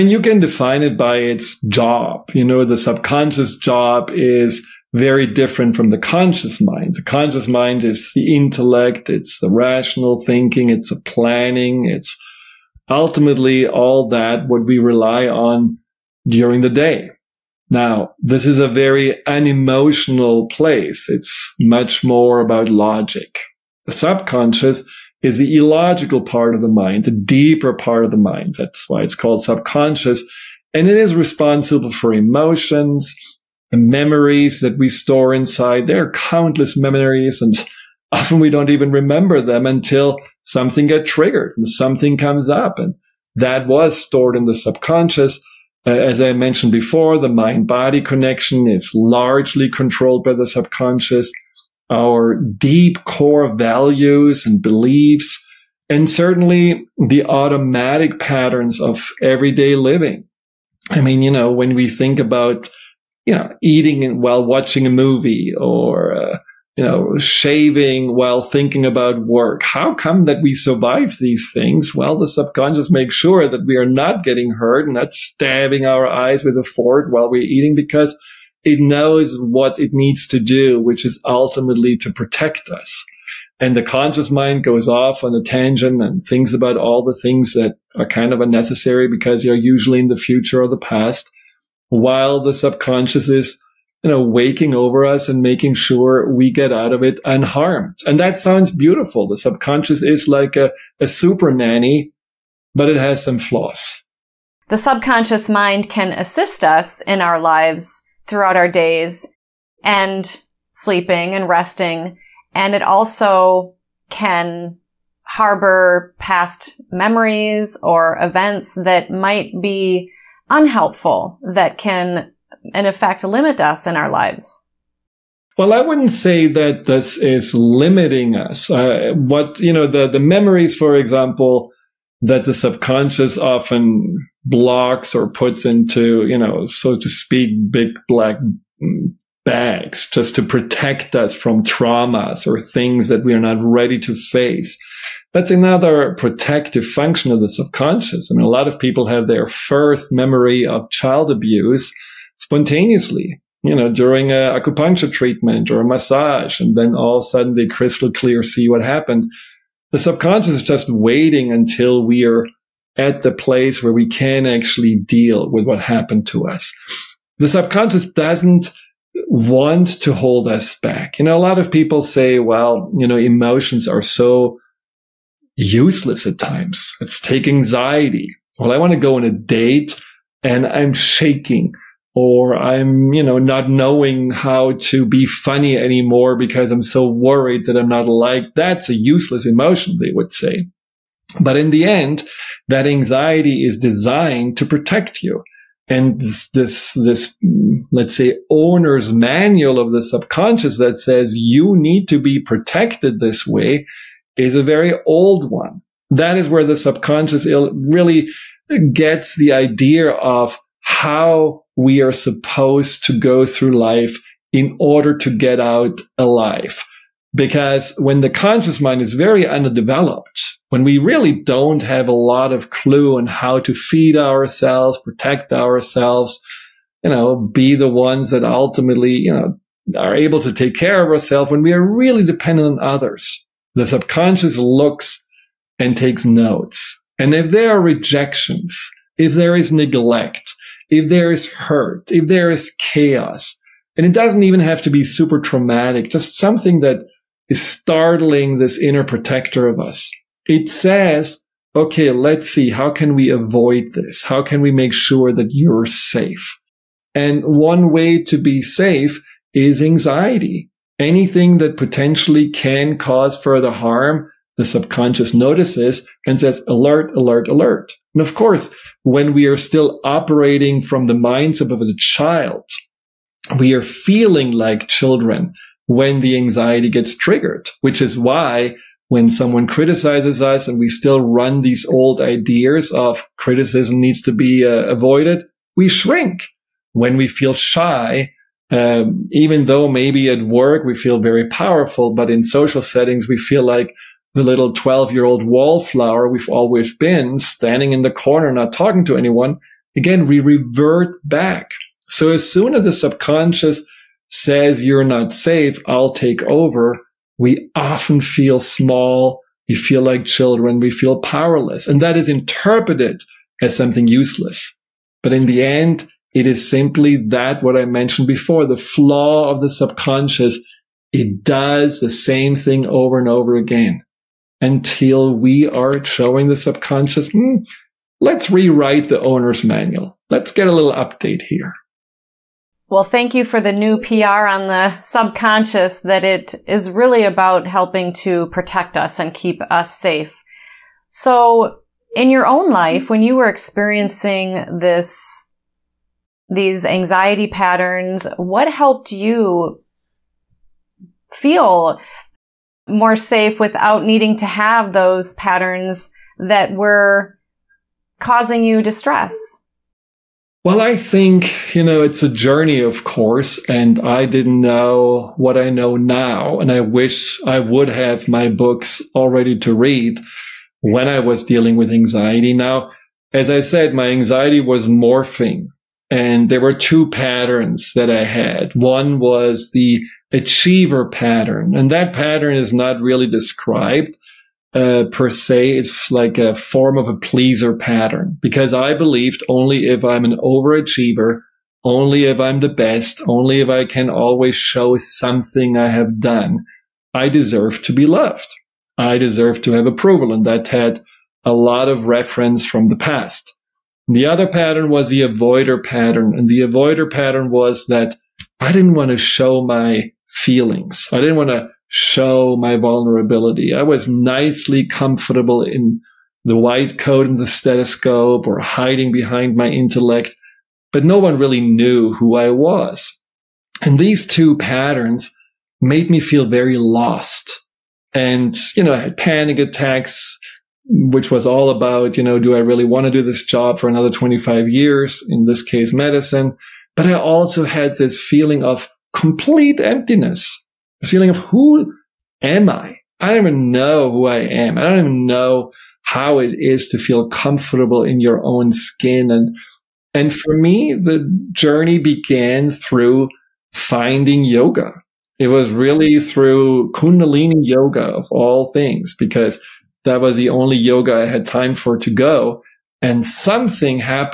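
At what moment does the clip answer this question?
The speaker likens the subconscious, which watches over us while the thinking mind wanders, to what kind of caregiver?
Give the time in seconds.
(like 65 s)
101 s.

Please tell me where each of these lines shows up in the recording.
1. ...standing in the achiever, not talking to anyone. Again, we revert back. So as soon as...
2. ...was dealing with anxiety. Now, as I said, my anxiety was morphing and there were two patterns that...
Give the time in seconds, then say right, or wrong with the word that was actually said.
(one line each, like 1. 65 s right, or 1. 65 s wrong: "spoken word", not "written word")
1. 297 s wrong: "corner", not "achiever"
2. 371 s right.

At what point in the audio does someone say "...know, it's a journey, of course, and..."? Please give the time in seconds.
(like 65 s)
361 s.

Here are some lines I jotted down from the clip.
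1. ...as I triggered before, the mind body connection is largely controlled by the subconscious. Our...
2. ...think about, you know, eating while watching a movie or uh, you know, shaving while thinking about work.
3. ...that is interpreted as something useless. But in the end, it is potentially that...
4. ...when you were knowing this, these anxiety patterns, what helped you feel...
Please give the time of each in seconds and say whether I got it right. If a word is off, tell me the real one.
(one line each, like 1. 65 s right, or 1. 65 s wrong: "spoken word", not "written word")
1. 45 s wrong: "mentioned", not "triggered"
2. 61 s right
3. 312 s wrong: "simply", not "potentially"
4. 343 s wrong: "experiencing", not "knowing".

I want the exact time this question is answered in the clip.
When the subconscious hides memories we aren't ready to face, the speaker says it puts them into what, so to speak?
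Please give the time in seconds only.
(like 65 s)
137 s.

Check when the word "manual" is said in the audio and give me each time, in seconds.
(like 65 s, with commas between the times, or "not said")
199 s, 329 s.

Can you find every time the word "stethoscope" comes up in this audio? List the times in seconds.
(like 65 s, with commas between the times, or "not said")
417 s.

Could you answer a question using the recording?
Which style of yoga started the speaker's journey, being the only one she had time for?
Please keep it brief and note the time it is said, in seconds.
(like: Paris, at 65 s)
Kundalini, at 456 s.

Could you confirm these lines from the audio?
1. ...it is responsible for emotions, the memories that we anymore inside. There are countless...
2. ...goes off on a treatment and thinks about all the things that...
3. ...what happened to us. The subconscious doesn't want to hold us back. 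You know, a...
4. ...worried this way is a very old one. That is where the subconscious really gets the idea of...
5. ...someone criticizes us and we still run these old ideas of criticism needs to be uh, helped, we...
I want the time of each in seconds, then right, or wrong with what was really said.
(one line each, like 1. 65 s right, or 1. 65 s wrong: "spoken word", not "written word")
1. 30 s wrong: "store", not "anymore"
2. 84 s wrong: "tangent", not "treatment"
3. 165 s right
4. 202 s wrong: "protected", not "worried"
5. 279 s wrong: "avoided", not "helped".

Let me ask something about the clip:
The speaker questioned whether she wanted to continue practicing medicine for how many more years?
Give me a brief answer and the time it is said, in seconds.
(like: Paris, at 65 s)
25, at 434 s.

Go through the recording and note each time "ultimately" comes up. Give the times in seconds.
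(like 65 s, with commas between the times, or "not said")
12 s, 81 s, 228 s.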